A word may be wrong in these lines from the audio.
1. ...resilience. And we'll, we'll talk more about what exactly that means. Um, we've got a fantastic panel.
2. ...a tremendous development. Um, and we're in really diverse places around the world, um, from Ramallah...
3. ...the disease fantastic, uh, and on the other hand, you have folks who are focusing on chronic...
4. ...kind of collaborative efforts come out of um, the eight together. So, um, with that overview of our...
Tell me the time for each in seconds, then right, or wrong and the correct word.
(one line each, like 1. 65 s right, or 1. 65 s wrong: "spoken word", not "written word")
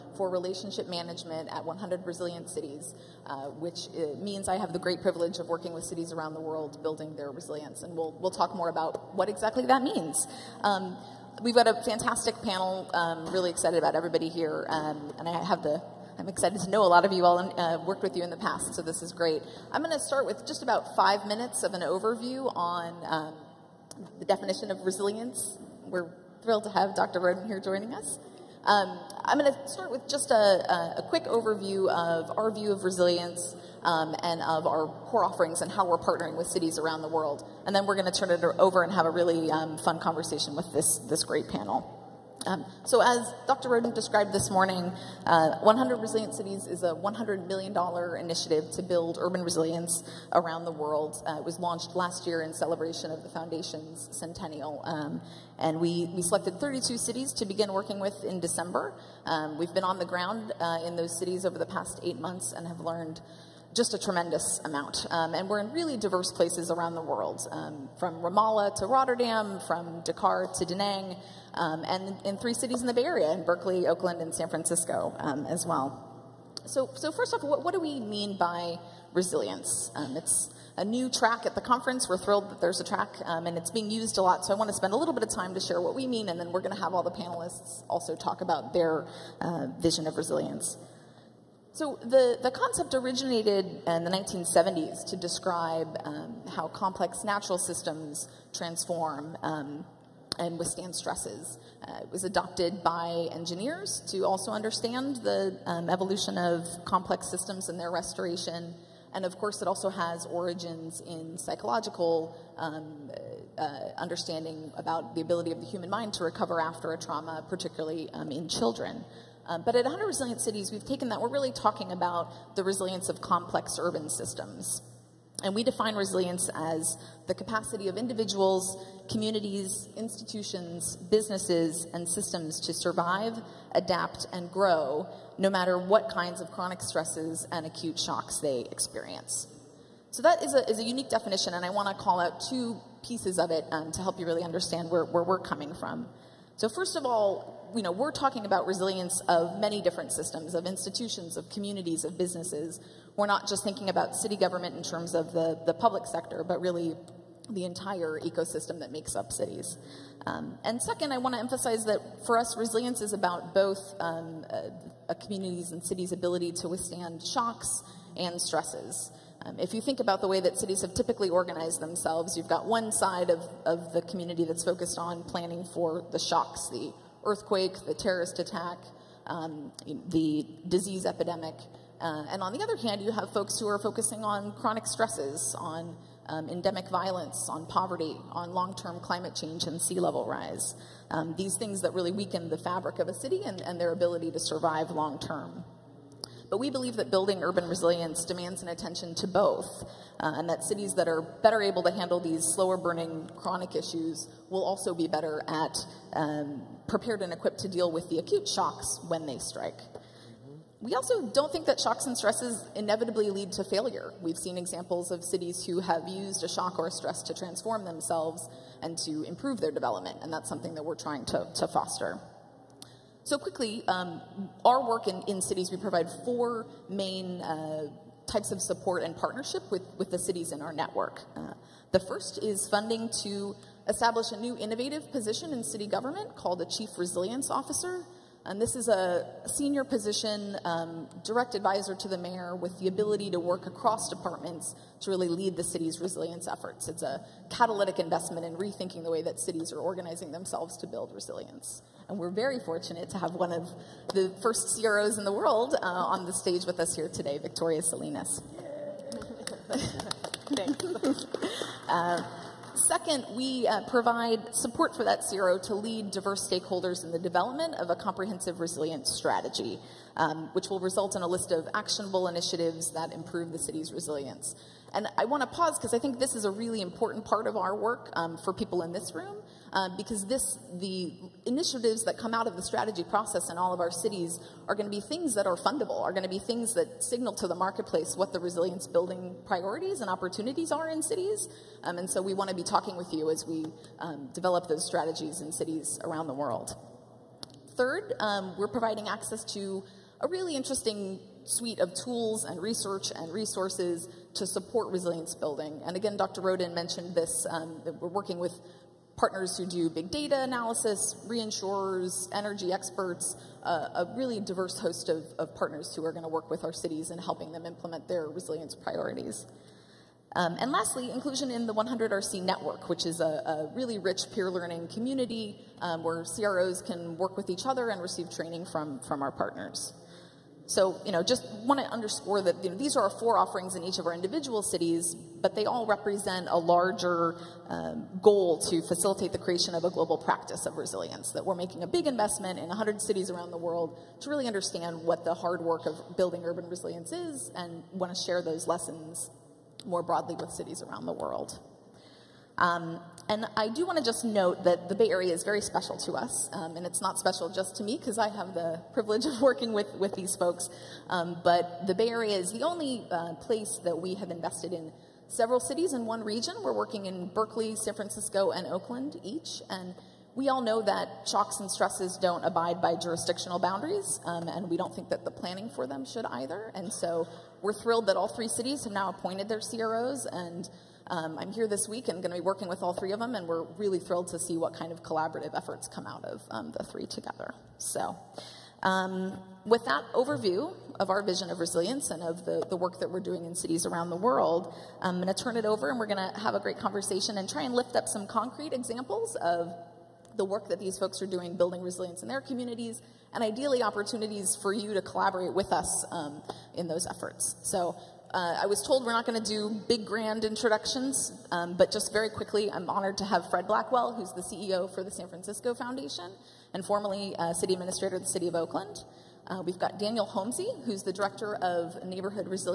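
1. 7 s right
2. 63 s wrong: "amount", not "development"
3. 180 s wrong: "epidemic", not "fantastic"
4. 384 s wrong: "three", not "eight".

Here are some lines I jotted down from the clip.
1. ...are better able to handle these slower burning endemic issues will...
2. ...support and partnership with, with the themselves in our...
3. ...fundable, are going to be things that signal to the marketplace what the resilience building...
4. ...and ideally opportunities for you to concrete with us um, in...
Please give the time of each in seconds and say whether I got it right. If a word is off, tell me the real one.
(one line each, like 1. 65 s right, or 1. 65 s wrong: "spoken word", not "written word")
1. 201 s wrong: "chronic", not "endemic"
2. 228 s wrong: "cities", not "themselves"
3. 285 s right
4. 403 s wrong: "collaborate", not "concrete".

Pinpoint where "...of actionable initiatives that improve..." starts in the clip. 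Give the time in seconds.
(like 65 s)
271 s.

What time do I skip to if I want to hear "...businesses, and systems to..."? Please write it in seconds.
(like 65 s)
131 s.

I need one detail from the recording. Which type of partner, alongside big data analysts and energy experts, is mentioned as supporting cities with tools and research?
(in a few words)
reinsurers.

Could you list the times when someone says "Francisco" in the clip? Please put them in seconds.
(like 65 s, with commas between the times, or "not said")
74 s, 367 s, 415 s.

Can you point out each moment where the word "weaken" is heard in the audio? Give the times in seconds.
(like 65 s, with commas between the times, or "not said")
192 s.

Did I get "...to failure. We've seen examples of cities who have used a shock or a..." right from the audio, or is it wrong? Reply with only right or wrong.
right.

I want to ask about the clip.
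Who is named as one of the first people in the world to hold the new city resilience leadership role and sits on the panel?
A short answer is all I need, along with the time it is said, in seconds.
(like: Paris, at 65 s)
Victoria Salinas, at 257 s.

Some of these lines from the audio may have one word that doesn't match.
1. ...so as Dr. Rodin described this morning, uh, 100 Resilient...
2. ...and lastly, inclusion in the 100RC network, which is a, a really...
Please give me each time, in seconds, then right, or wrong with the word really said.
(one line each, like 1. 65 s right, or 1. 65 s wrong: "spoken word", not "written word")
1. 42 s right
2. 320 s right.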